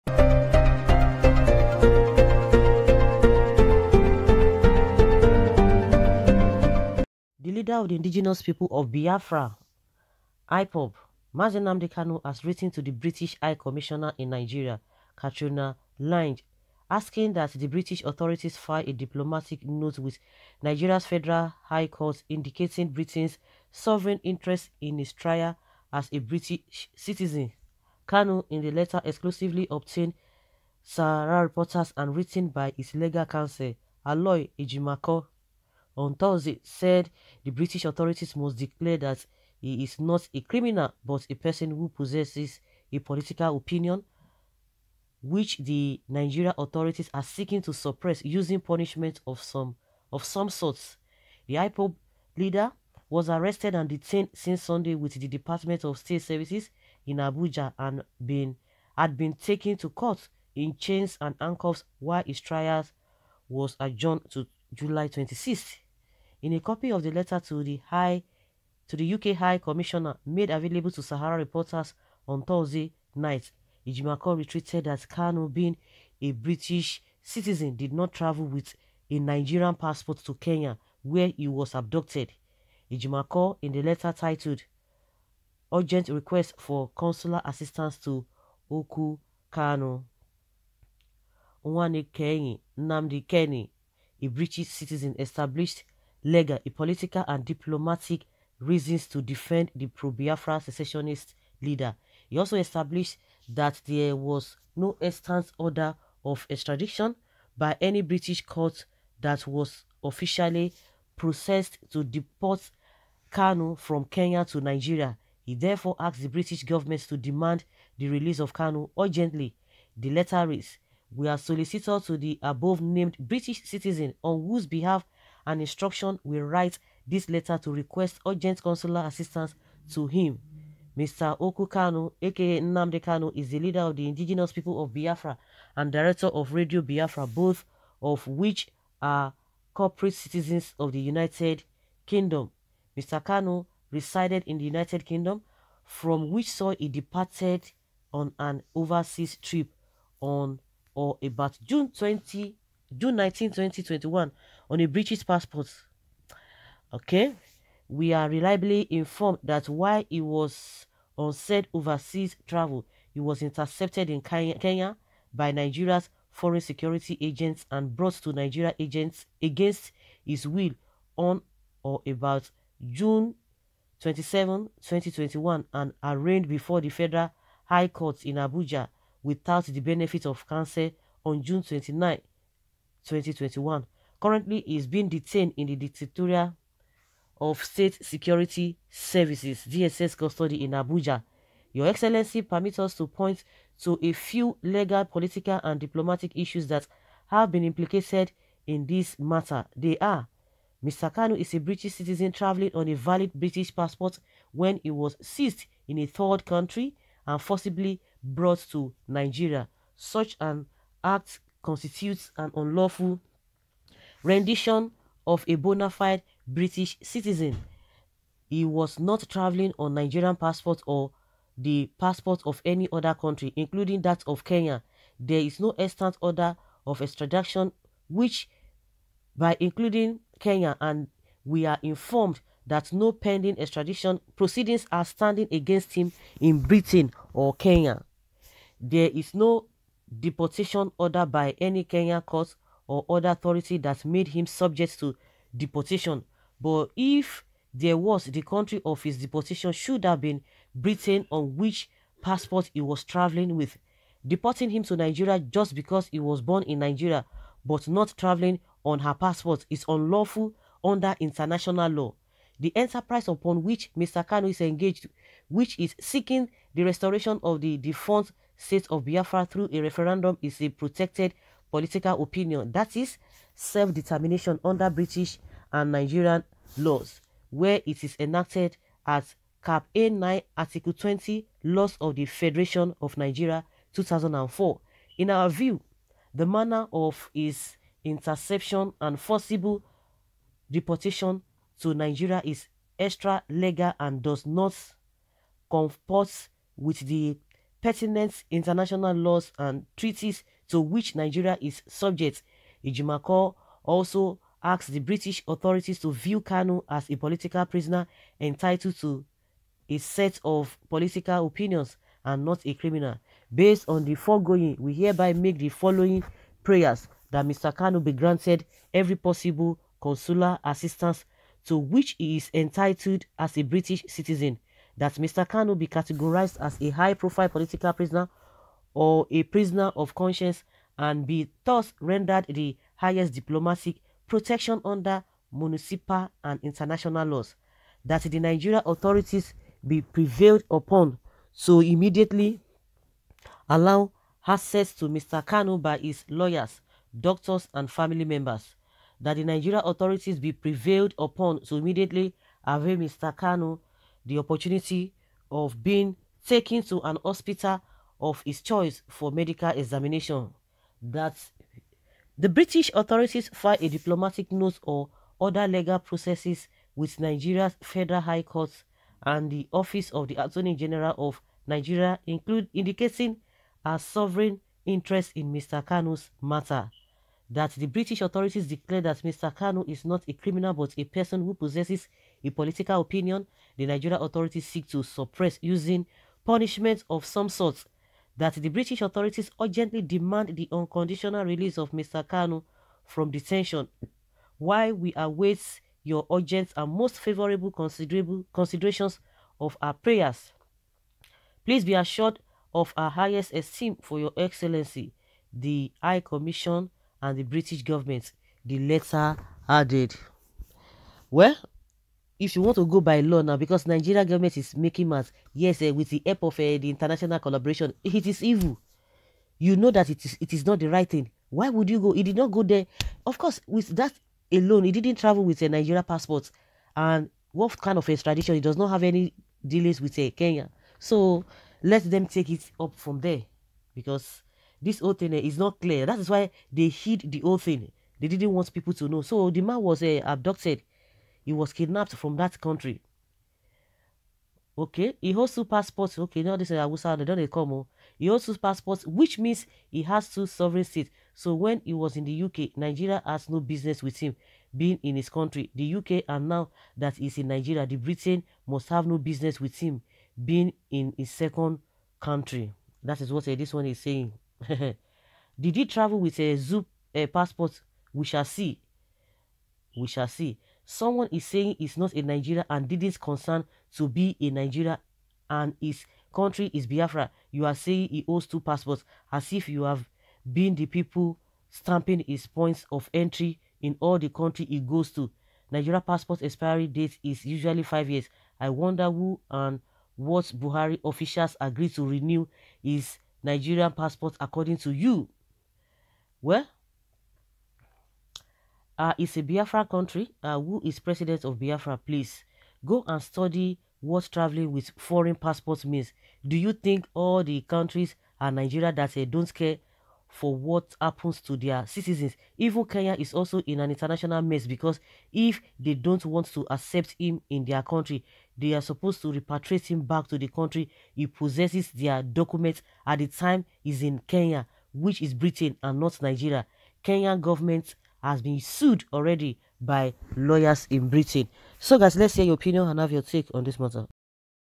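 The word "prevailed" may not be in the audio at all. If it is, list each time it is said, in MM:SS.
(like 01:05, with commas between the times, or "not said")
05:40, 05:50.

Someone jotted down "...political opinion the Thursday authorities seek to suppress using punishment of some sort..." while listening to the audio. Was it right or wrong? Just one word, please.
wrong.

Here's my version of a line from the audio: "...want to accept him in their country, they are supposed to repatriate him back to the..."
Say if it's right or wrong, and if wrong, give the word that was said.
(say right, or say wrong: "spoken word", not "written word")
right.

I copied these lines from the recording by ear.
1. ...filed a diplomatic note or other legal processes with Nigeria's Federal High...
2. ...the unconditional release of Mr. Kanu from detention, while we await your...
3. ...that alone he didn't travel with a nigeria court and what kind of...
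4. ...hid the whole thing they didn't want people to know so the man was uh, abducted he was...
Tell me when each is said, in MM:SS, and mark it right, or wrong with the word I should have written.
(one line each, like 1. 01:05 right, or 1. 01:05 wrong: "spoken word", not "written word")
1. 06:03 right
2. 06:30 right
3. 07:03 wrong: "passport", not "court"
4. 07:16 right.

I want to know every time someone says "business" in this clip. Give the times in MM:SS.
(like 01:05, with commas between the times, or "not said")
07:33, 07:39.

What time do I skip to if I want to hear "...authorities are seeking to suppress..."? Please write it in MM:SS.
00:46.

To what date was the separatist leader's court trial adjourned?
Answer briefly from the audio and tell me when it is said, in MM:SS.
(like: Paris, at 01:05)
July 26th, at 01:04.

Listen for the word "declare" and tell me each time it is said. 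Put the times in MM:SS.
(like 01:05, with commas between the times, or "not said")
00:38, 06:18.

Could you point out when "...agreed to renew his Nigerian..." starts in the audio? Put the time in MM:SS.
08:11.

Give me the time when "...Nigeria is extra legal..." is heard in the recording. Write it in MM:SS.
04:51.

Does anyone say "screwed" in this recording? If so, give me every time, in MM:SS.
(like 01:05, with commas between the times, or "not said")
not said.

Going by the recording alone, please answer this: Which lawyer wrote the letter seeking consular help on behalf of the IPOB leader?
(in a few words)
Aloy Ejimakor.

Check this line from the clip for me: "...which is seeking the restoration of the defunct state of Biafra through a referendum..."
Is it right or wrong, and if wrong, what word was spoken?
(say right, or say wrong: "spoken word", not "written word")
right.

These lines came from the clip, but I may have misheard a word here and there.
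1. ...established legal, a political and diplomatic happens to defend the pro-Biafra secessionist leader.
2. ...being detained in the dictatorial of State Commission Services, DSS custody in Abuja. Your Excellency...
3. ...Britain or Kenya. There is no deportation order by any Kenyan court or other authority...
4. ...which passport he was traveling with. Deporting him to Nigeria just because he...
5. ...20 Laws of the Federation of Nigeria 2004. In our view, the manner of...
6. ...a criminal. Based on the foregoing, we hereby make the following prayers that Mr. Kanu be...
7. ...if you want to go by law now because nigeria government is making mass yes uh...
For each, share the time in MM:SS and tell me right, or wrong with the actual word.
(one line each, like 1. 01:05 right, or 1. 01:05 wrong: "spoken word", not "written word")
1. 01:35 wrong: "reasons", not "happens"
2. 03:04 wrong: "Security", not "Commission"
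3. 03:56 right
4. 04:11 right
5. 04:40 right
6. 05:12 right
7. 06:52 right.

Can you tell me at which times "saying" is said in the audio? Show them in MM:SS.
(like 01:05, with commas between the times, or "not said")
07:43, 07:51, 07:57.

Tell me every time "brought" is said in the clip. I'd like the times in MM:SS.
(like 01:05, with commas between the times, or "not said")
02:47, 03:28.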